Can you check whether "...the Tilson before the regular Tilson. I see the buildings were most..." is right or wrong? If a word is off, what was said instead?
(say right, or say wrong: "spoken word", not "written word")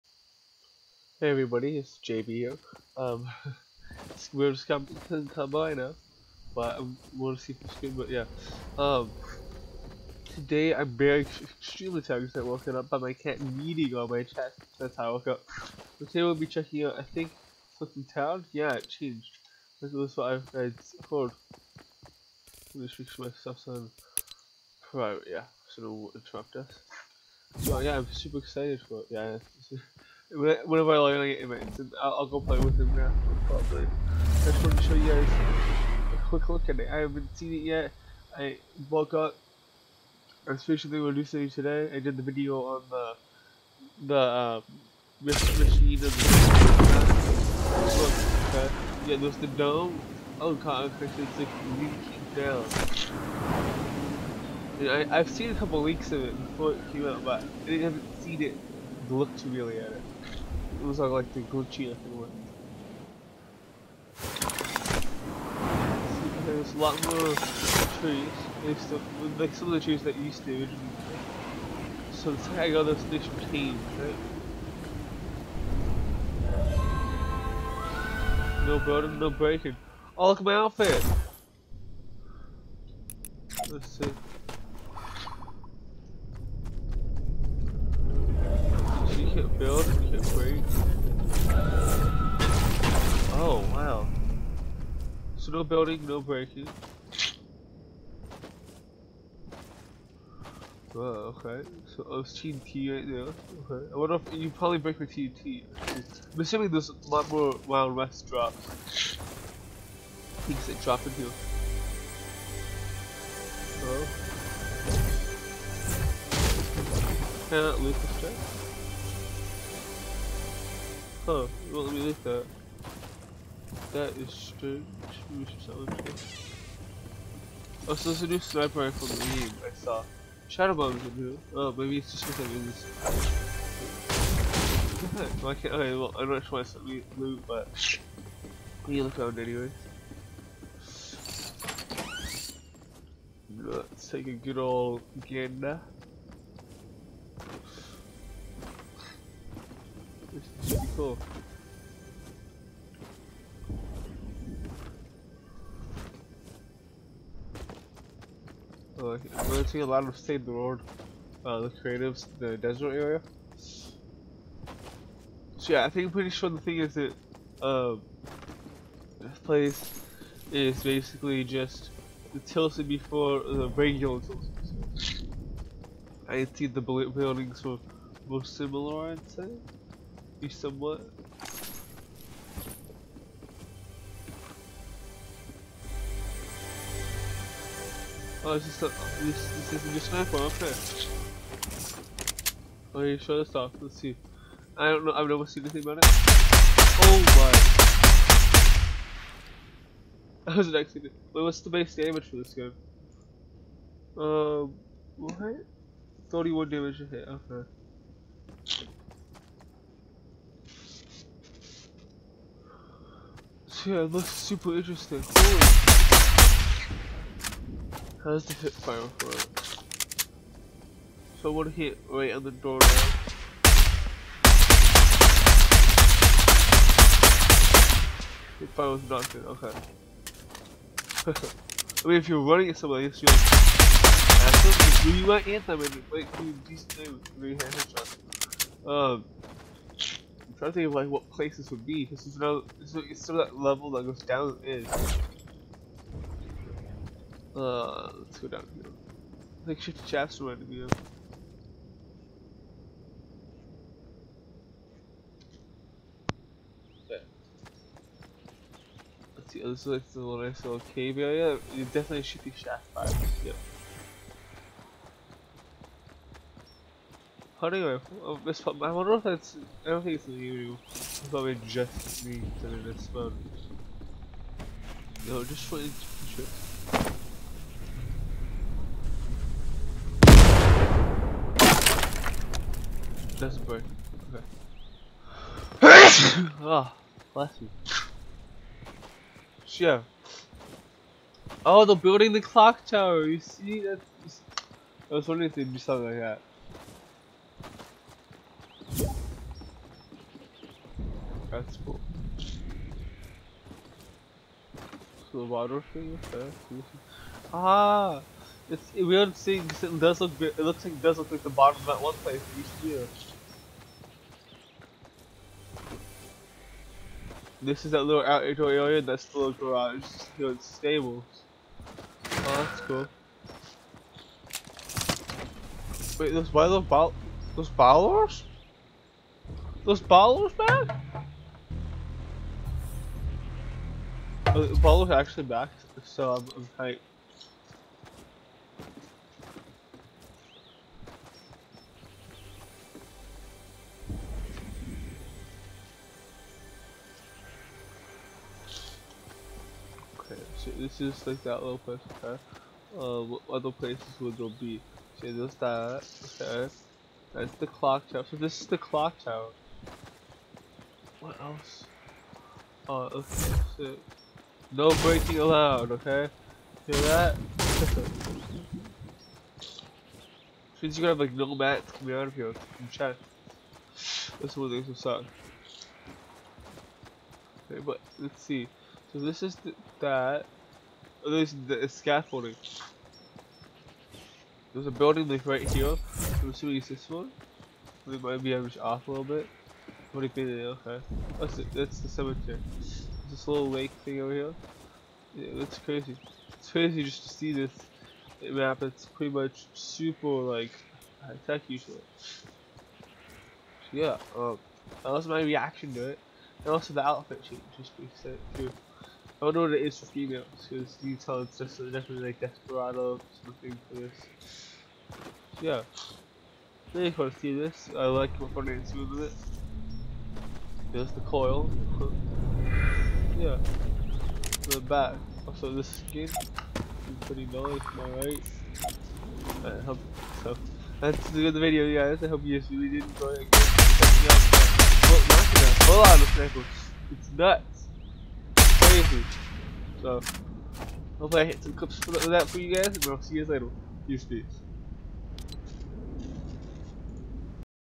right.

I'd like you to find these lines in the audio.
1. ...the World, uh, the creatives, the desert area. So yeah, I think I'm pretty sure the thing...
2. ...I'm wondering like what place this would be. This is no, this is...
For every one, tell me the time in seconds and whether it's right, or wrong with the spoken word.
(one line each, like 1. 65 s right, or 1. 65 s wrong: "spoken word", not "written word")
1. 160 s right
2. 240 s wrong: "thinking", not "wondering".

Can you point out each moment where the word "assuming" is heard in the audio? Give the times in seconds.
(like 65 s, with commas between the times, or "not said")
106 s, 386 s.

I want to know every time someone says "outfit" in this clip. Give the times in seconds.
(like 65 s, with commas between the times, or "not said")
80 s, 407 s.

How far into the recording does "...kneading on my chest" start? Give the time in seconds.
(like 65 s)
13 s.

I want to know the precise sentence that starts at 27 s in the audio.
So yeah, I'm super excited for it, yeah.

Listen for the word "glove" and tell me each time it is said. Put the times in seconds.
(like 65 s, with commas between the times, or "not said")
not said.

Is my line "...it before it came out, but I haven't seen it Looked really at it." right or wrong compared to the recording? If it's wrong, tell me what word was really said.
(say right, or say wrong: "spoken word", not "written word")
right.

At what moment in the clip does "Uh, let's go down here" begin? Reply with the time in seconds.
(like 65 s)
247 s.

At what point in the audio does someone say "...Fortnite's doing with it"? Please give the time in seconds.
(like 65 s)
418 s.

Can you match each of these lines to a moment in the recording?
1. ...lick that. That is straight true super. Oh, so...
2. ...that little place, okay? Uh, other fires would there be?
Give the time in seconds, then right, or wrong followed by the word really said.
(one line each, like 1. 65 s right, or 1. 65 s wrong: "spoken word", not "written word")
1. 122 s wrong: "soldier", not "super"
2. 351 s wrong: "places", not "fires".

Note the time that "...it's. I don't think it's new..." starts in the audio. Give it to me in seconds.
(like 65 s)
269 s.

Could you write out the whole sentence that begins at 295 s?
I was wondering if they'd do something like that.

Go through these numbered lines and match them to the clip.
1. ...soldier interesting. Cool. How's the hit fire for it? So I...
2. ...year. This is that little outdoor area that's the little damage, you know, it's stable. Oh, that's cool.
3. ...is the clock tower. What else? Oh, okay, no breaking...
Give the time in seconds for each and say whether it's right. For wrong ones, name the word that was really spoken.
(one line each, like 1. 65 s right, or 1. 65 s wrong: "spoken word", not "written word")
1. 214 s wrong: "super", not "soldier"
2. 312 s wrong: "garage", not "damage"
3. 358 s right.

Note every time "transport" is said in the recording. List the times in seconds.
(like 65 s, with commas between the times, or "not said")
not said.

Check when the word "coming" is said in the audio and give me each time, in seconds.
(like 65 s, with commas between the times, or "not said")
4 s, 371 s.